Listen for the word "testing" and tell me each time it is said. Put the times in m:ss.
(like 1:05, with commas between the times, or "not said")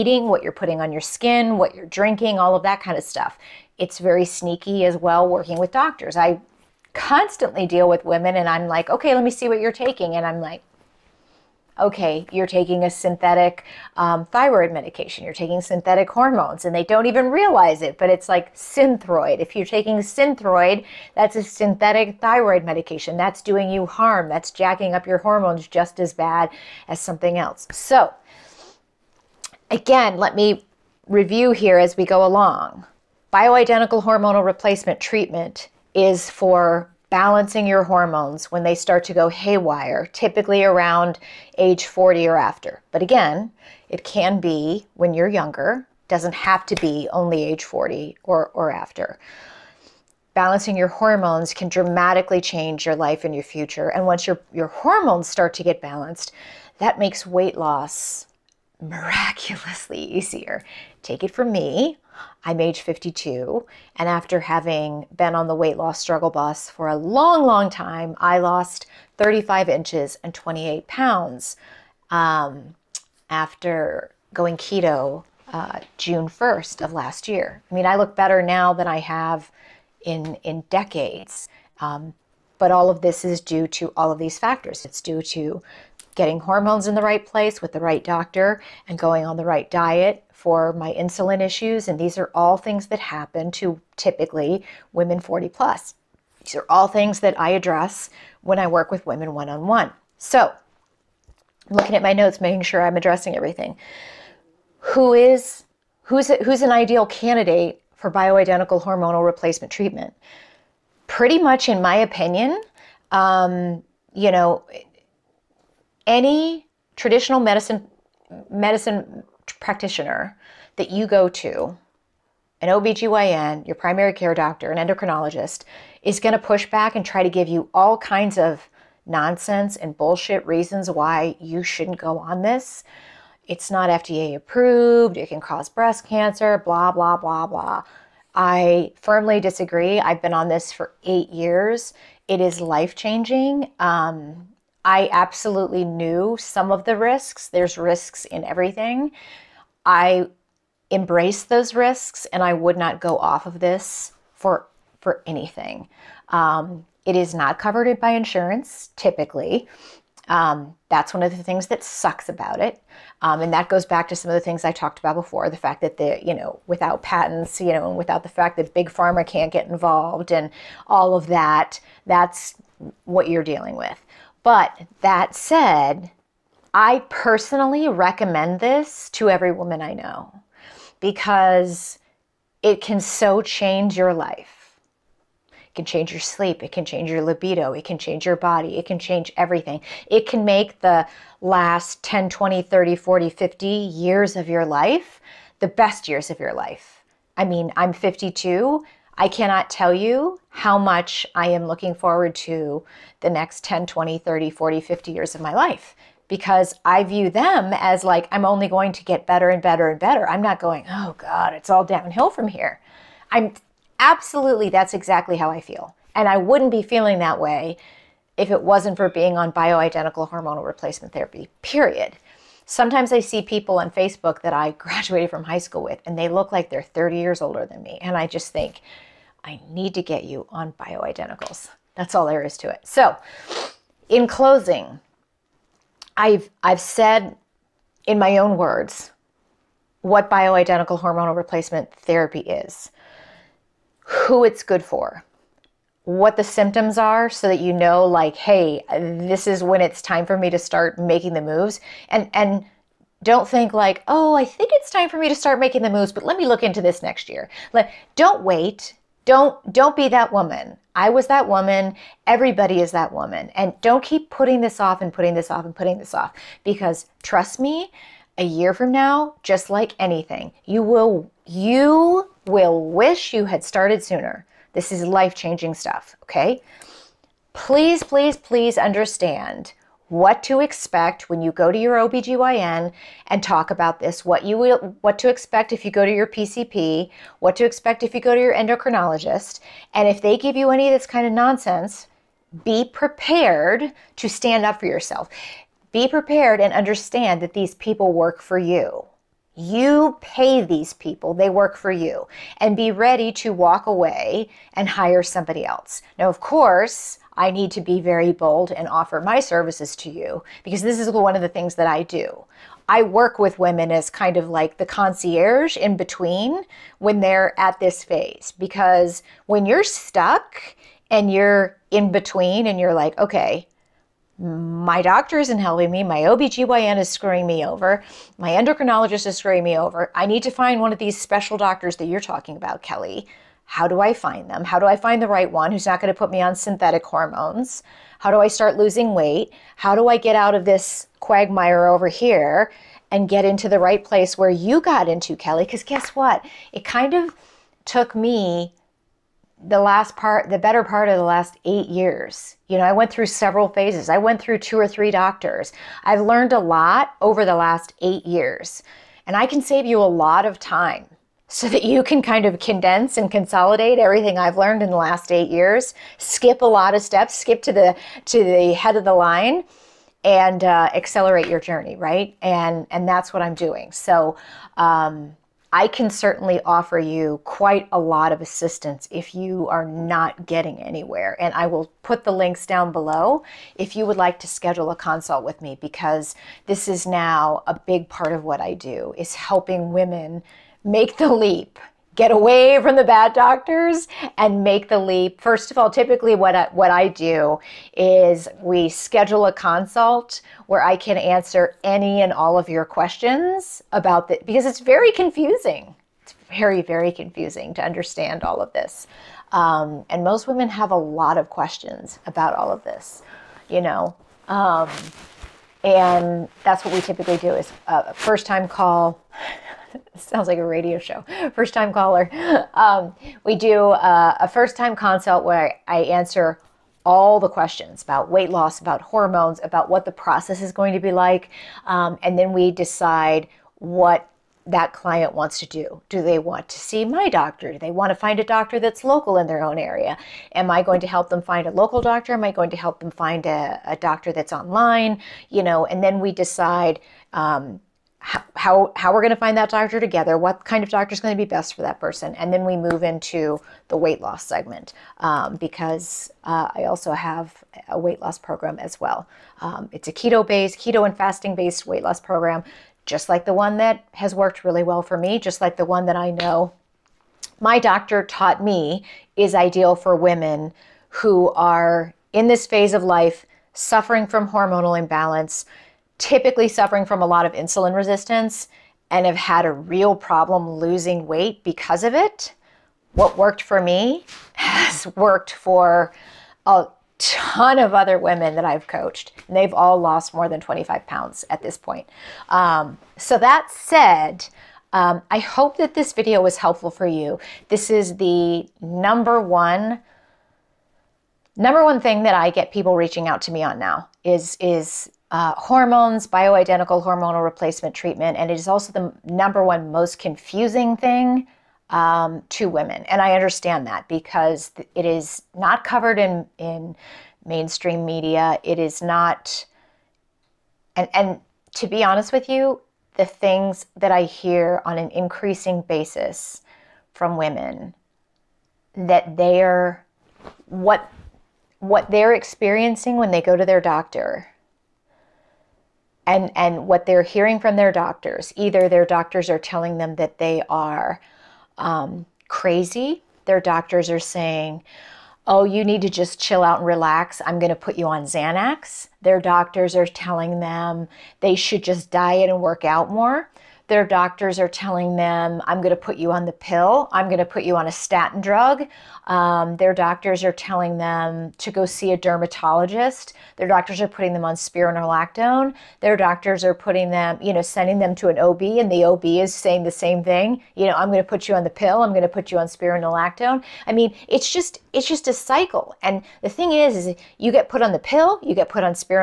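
not said.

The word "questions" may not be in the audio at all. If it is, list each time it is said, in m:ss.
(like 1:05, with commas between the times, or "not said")
6:42, 6:51, 7:07.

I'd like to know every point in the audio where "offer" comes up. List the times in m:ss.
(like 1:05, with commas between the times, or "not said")
5:08, 6:16.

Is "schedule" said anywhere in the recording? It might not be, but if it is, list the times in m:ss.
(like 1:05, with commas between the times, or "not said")
6:24, 6:38.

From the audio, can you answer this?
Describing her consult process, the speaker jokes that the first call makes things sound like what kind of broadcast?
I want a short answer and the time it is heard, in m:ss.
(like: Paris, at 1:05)
radio show, at 7:00.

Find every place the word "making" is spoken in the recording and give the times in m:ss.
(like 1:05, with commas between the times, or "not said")
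1:42, 4:10, 4:15.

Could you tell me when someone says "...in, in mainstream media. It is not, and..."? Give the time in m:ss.
8:36.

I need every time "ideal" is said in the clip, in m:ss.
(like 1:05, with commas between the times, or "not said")
1:46, 7:49.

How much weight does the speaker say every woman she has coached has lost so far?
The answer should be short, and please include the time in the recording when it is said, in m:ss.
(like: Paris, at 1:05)
more than 25 pounds, at 8:10.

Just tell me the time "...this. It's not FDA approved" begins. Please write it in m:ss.
2:12.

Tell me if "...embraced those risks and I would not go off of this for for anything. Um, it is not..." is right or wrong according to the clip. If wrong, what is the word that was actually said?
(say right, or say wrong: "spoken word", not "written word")
right.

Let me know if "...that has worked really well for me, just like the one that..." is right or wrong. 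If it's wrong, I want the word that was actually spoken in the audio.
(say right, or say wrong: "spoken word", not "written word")
right.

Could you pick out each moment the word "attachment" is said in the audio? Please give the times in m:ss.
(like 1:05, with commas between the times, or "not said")
not said.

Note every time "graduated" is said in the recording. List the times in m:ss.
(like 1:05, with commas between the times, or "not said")
3:44.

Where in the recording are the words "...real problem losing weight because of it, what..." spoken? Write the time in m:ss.
7:59.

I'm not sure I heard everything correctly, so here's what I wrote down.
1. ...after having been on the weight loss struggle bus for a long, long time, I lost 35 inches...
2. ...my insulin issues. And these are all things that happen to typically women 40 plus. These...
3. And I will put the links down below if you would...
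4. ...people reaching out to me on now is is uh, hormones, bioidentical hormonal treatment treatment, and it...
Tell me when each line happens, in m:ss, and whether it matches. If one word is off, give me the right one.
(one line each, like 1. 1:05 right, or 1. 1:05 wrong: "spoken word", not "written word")
1. 1:04 right
2. 1:30 right
3. 6:21 right
4. 8:22 wrong: "replacement", not "treatment".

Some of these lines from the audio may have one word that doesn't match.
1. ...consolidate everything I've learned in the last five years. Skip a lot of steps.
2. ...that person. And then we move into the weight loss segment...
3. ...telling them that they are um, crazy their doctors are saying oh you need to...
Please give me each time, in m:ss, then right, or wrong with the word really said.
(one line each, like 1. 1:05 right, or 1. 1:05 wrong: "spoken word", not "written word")
1. 6:03 wrong: "eight", not "five"
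2. 7:31 right
3. 8:59 right.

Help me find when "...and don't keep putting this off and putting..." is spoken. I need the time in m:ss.
4:23.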